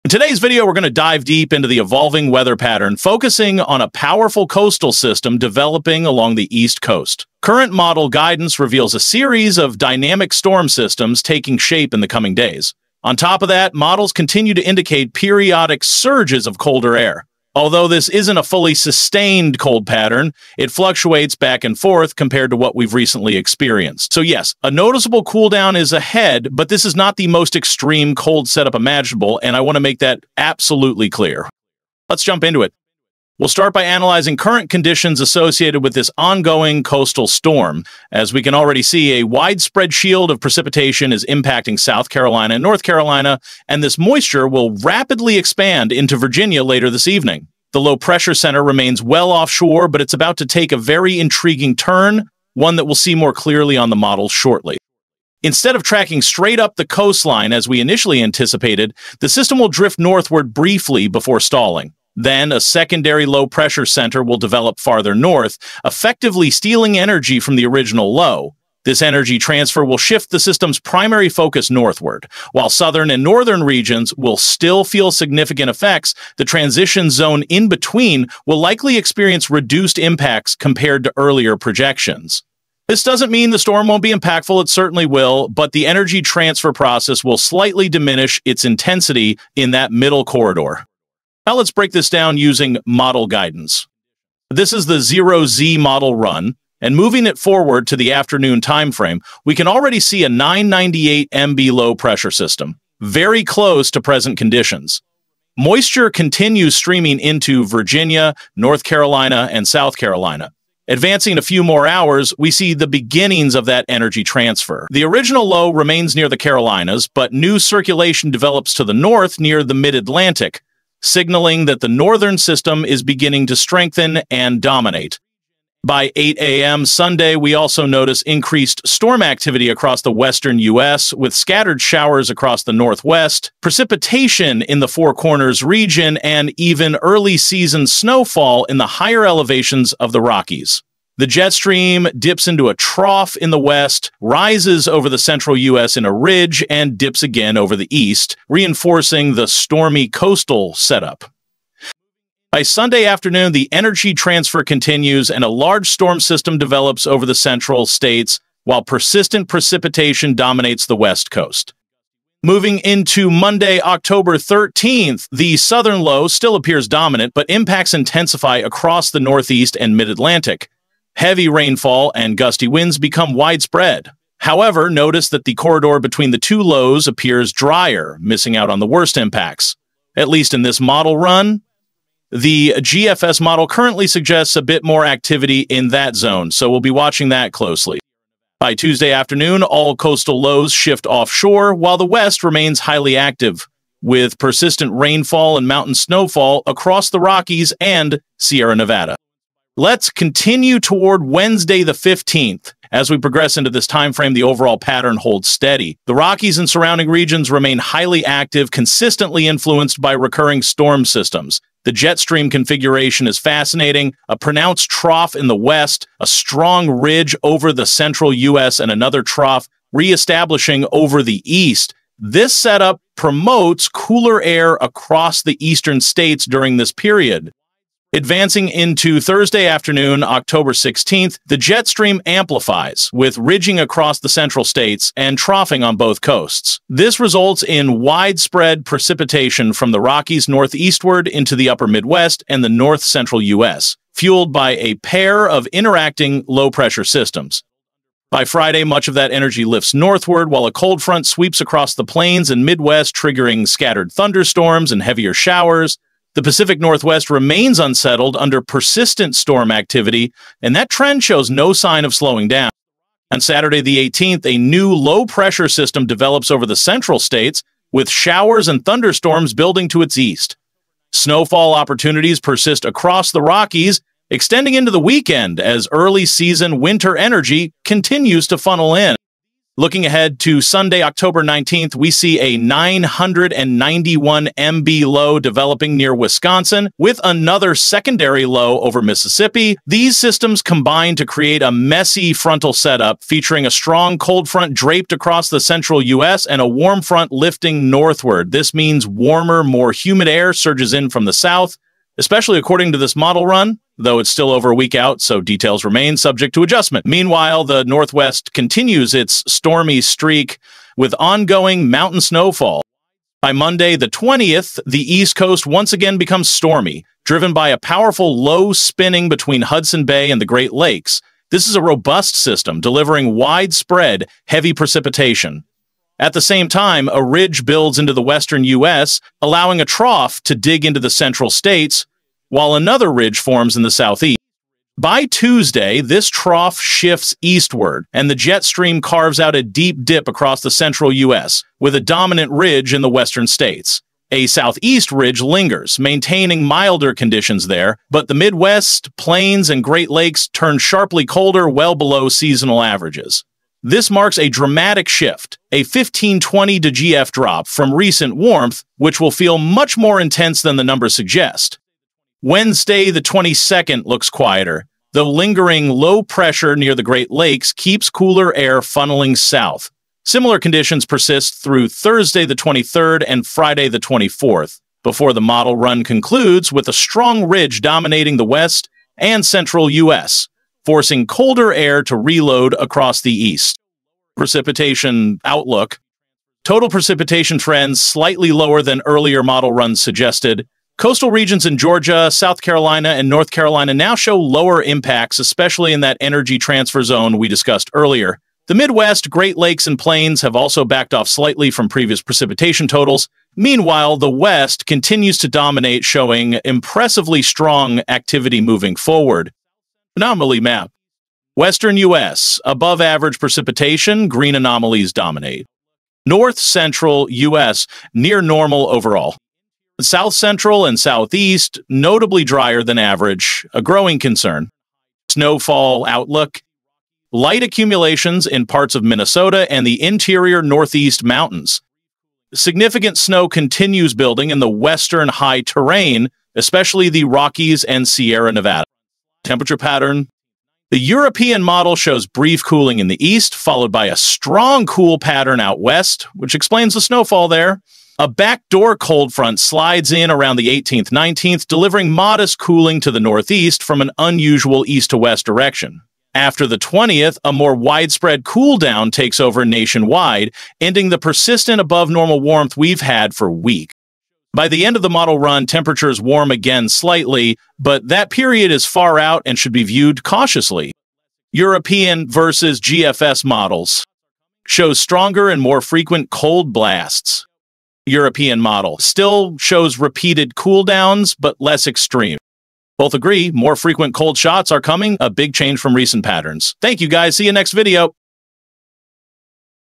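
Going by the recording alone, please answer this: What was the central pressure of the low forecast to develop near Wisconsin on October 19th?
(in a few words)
991 MB.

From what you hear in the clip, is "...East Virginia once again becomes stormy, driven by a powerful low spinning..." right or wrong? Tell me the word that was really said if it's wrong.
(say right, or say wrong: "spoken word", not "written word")
wrong: "Coast", not "Virginia".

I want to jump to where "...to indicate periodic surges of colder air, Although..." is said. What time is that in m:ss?
0:14.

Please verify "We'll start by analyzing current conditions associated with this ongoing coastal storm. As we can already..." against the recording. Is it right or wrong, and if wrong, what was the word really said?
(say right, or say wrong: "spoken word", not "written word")
right.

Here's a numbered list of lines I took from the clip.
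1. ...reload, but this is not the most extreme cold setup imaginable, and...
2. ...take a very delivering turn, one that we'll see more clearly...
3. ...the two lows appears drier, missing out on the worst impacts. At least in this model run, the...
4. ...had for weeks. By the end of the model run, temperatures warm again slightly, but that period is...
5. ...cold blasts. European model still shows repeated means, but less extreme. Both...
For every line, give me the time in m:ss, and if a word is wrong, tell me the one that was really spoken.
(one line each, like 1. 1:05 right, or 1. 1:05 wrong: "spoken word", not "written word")
1. 0:25 wrong: "ahead", not "reload"
2. 0:50 wrong: "intriguing", not "delivering"
3. 2:56 right
4. 7:43 right
5. 7:56 wrong: "cooldowns", not "means".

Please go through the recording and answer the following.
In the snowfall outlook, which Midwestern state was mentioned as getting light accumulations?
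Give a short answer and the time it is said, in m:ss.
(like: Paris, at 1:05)
Minnesota, at 7:09.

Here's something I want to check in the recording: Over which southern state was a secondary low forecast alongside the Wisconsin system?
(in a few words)
Mississippi.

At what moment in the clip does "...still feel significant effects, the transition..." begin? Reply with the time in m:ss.
1:14.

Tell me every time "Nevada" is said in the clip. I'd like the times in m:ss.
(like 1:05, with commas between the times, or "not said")
3:18, 7:18.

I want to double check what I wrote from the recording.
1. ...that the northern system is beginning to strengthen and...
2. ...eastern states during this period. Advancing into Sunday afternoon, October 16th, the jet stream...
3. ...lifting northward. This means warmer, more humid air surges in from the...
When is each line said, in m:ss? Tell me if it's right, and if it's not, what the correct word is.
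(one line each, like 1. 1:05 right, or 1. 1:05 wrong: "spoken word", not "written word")
1. 2:01 right
2. 3:45 wrong: "Thursday", not "Sunday"
3. 4:57 right.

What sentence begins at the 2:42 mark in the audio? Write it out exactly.
Moving into Monday, October 13th, the southern low still appears dominant, but impacts intensify across the northeast and mid-Atlantic.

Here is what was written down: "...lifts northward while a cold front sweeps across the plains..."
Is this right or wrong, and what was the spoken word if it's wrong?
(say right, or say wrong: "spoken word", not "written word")
right.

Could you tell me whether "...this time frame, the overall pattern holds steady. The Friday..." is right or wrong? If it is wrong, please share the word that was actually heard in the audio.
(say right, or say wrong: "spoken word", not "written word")
wrong: "Rockies", not "Friday".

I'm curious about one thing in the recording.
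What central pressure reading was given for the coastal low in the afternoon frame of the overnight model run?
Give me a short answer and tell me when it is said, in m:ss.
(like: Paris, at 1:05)
998 MB, at 1:40.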